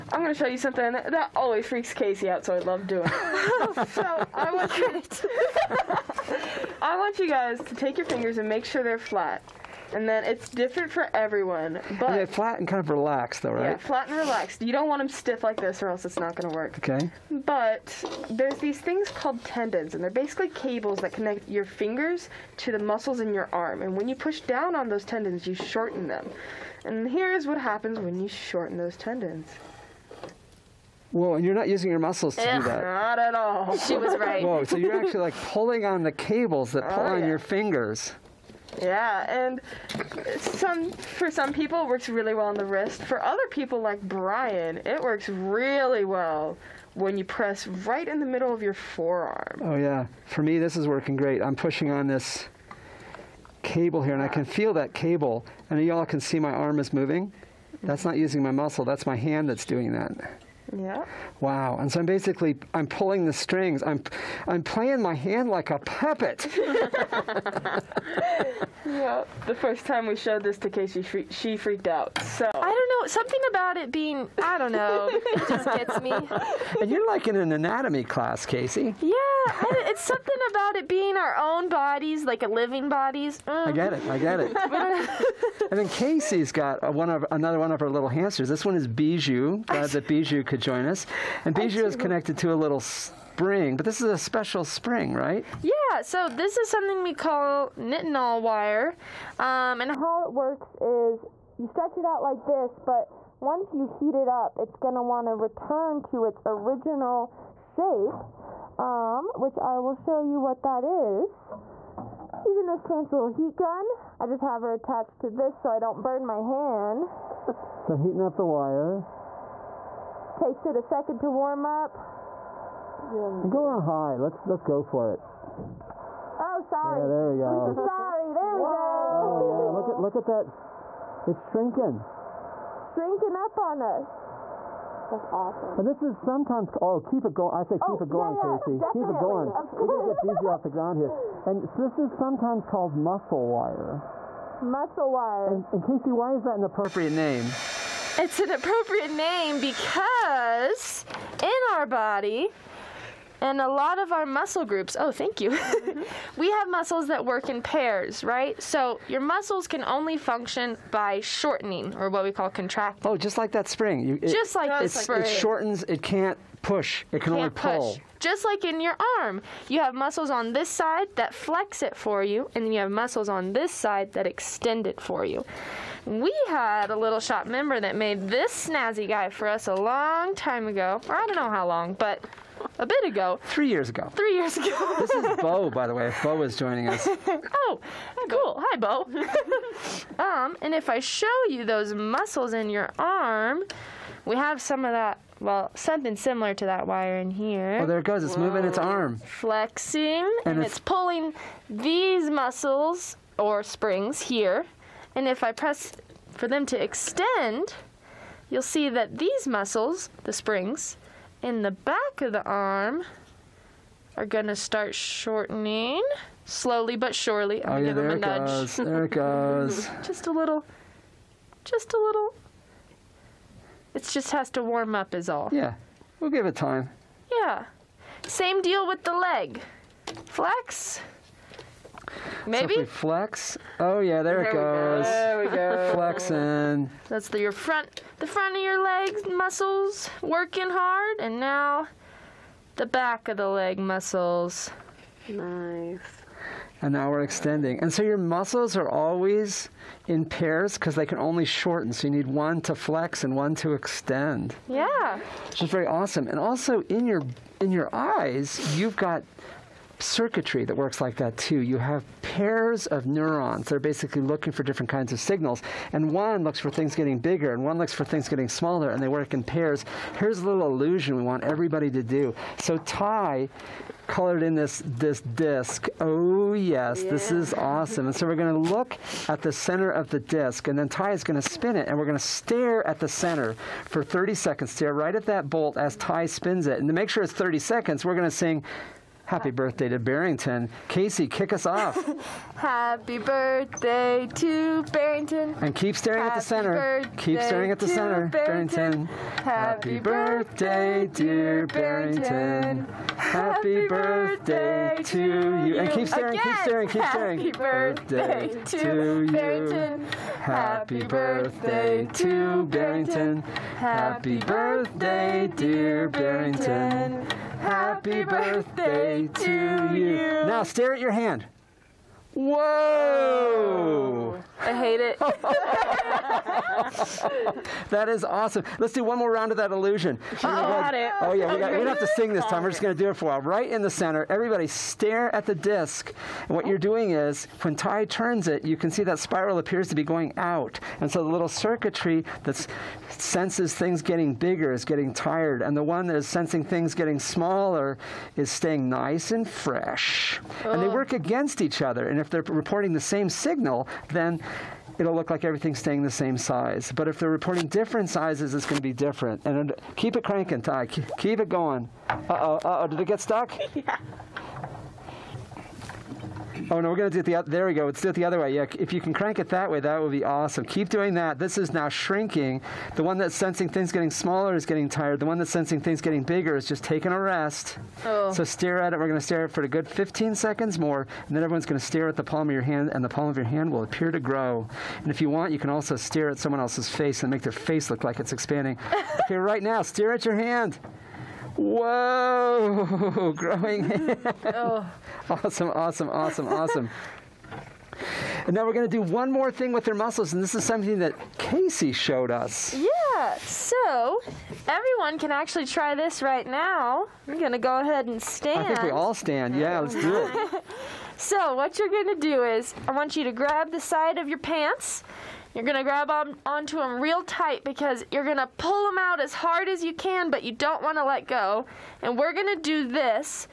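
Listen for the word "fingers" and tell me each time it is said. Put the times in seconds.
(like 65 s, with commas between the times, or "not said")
8 s, 21 s, 37 s.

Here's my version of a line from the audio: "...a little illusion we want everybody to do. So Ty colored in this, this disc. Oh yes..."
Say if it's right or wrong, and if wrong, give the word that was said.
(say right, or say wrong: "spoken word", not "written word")
right.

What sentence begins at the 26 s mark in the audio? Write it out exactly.
And here is what happens when you shorten those tendons.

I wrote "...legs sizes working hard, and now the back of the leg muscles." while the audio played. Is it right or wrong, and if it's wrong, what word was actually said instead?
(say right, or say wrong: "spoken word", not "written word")
wrong: "muscles", not "sizes".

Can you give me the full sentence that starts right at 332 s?
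We're just going to do it for a while.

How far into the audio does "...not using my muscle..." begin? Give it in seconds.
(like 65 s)
58 s.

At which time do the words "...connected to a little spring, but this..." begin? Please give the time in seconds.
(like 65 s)
91 s.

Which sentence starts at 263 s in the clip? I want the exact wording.
that are basically looking for different kinds of signals.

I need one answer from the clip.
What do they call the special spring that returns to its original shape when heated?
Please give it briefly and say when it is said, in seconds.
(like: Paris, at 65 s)
knit wire, at 97 s.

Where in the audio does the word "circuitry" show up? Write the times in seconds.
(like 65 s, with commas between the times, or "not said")
259 s, 341 s.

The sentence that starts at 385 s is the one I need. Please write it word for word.
And if you want, you can also stare at someone else's face and make their face look like it's expanding.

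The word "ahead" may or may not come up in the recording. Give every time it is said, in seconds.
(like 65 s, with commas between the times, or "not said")
407 s.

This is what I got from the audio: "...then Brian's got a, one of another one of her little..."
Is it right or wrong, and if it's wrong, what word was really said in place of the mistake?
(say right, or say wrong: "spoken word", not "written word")
wrong: "Casey", not "Brian".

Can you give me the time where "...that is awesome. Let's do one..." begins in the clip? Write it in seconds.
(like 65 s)
327 s.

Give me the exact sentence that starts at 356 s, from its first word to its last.
But if they're reporting different sizes, it's going to be different.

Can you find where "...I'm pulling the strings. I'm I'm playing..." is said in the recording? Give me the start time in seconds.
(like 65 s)
62 s.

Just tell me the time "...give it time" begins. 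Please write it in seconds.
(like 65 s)
226 s.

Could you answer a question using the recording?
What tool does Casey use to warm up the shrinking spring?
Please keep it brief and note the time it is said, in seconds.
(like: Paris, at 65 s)
heat gun, at 113 s.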